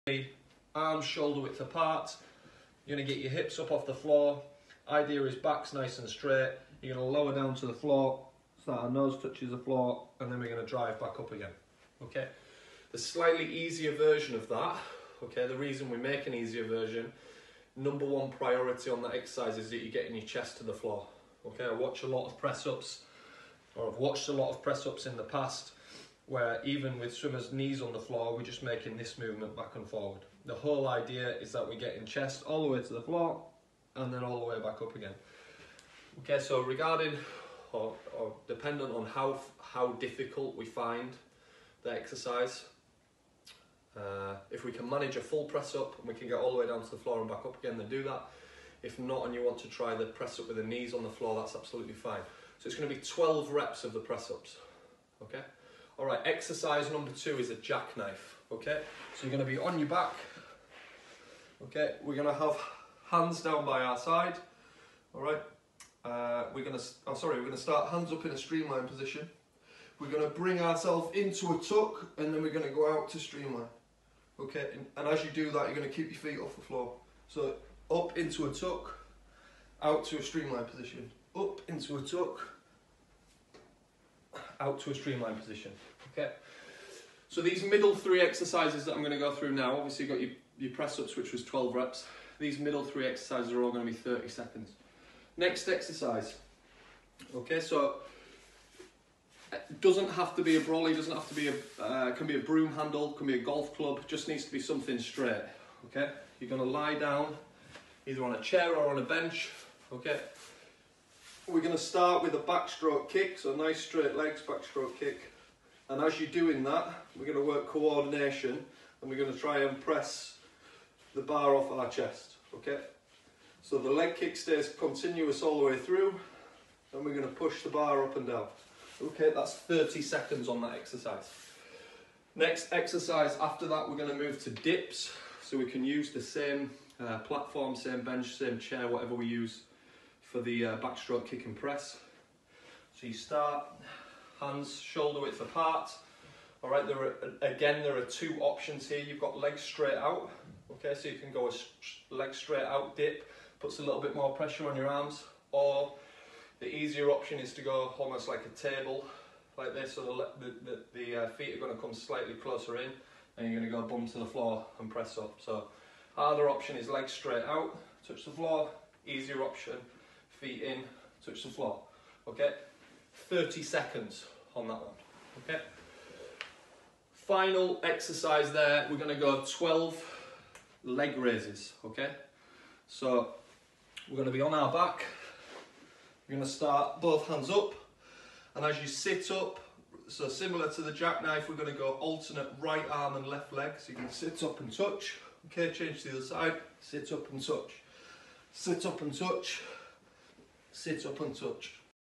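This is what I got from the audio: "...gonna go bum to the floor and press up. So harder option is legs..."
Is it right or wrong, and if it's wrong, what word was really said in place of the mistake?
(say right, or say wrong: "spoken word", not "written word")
right.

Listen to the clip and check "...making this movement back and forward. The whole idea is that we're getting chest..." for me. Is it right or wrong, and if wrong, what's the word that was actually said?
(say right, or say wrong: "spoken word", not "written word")
right.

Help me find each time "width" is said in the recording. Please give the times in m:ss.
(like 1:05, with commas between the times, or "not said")
0:01, 2:25.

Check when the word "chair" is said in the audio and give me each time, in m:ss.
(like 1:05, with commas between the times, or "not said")
1:48, 2:18.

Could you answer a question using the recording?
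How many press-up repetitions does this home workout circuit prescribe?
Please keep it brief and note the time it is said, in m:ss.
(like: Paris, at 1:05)
12, at 0:53.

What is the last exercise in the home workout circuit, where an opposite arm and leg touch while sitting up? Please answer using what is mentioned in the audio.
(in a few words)
Leg raises.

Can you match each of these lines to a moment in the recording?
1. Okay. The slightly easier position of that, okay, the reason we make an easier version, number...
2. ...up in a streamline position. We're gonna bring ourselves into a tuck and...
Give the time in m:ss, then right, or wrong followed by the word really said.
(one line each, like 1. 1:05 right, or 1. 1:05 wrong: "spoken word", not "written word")
1. 0:12 wrong: "version", not "position"
2. 1:08 right.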